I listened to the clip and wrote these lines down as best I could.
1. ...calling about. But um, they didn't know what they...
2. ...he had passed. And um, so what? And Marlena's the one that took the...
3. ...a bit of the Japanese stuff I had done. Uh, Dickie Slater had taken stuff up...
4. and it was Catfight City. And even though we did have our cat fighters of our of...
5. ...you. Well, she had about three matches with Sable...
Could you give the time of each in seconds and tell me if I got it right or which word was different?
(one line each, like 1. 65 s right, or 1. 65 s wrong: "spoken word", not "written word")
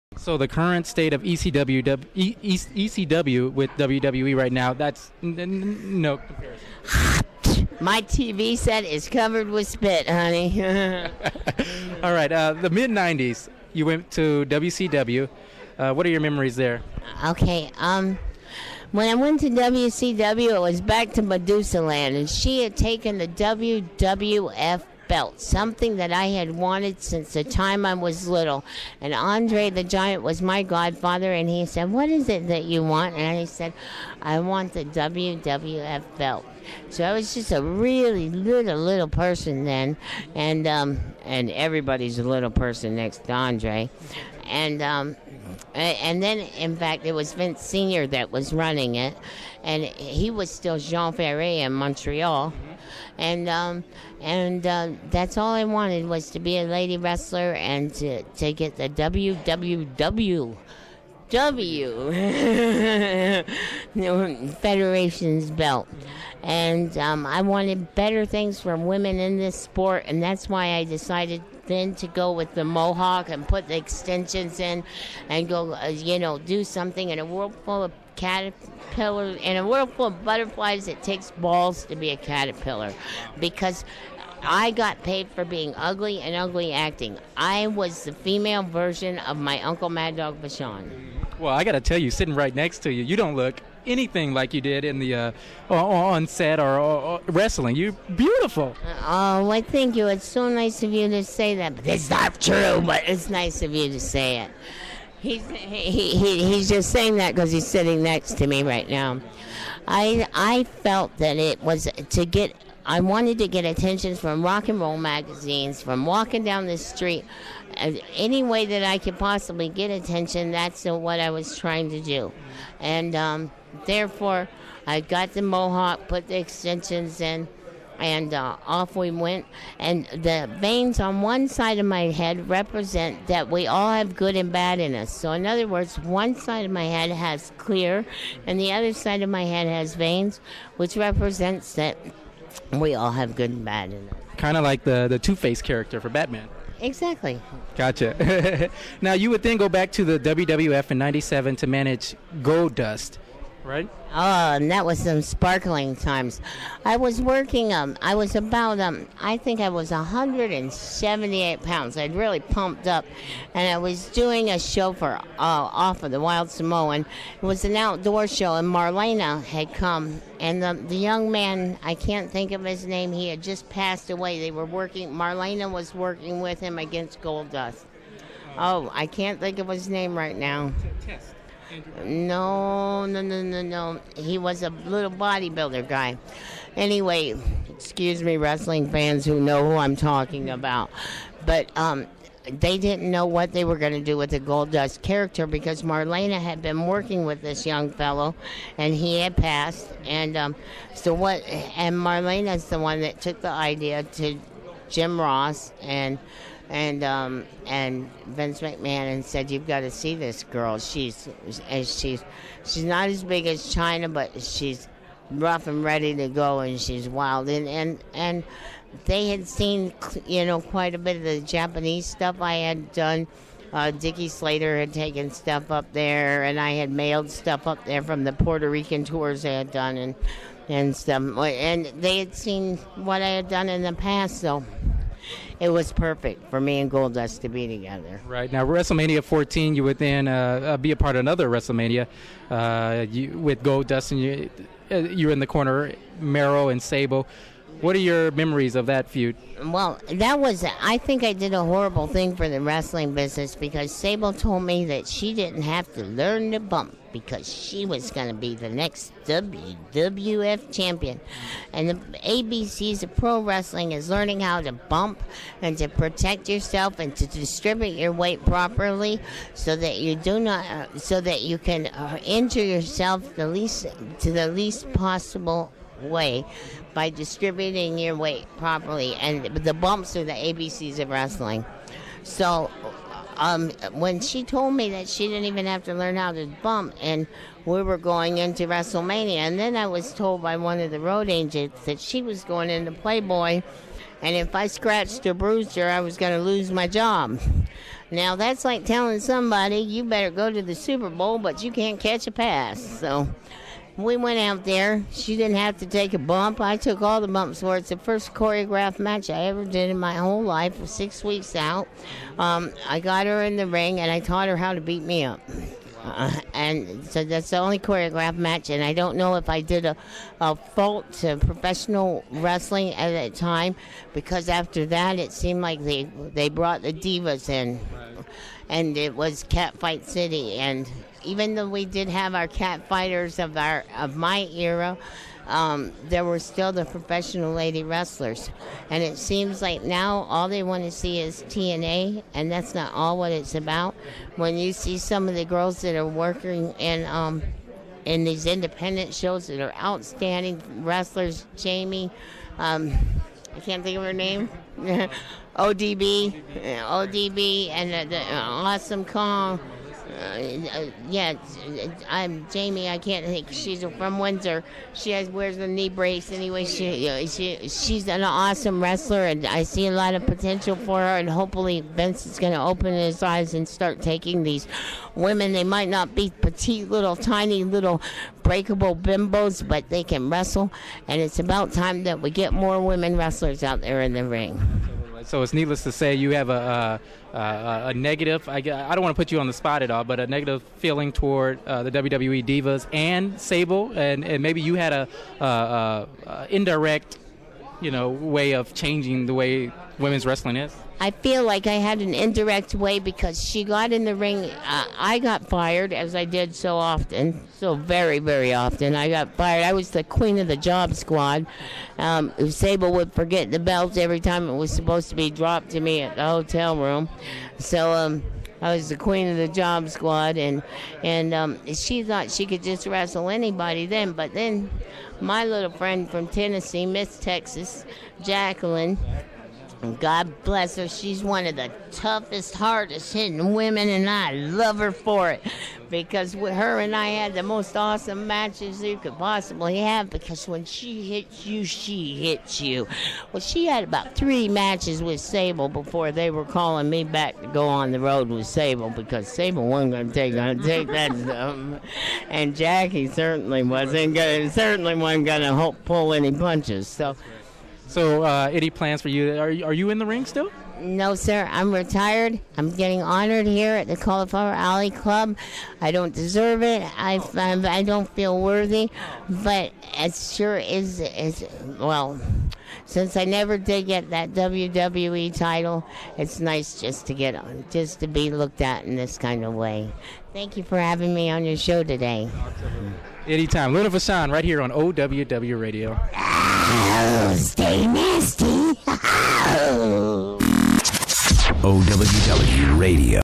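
1. 189 s wrong: "talking", not "calling"
2. 198 s right
3. 220 s right
4. 328 s right
5. 442 s right.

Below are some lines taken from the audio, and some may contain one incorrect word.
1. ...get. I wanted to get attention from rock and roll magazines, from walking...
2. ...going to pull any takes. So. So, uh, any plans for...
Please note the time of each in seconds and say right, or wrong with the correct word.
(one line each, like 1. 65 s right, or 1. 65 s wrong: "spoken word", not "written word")
1. 112 s right
2. 455 s wrong: "punches", not "takes".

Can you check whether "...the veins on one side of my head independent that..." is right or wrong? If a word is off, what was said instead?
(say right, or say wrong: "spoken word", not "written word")
wrong: "represent", not "independent".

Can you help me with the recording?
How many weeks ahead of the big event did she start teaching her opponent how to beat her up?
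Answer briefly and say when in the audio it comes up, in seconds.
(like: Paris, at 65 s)
6, at 310 s.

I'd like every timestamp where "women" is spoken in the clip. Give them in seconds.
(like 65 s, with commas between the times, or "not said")
68 s, 375 s, 382 s, 399 s, 433 s.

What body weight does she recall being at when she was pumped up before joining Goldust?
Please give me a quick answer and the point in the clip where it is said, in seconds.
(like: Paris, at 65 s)
178 pounds, at 159 s.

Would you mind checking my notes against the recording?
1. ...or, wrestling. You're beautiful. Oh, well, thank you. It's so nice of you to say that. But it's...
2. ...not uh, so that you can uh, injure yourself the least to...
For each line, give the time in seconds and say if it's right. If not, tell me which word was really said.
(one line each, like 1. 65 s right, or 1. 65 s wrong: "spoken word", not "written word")
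1. 96 s right
2. 270 s right.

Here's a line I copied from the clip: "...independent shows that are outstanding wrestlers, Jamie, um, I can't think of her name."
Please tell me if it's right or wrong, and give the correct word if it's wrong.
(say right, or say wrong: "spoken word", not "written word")
right.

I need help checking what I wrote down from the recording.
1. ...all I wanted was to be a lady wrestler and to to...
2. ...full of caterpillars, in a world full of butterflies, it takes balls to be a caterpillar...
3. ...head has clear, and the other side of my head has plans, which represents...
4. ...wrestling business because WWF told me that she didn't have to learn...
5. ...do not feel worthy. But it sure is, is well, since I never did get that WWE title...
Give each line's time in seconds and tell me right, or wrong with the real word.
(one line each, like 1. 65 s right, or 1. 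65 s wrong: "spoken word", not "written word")
1. 55 s right
2. 77 s right
3. 136 s wrong: "veins", not "plans"
4. 252 s wrong: "Sable", not "WWF"
5. 467 s right.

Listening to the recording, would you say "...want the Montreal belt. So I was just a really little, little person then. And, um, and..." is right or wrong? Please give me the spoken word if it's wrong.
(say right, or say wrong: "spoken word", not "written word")
wrong: "WWF", not "Montreal".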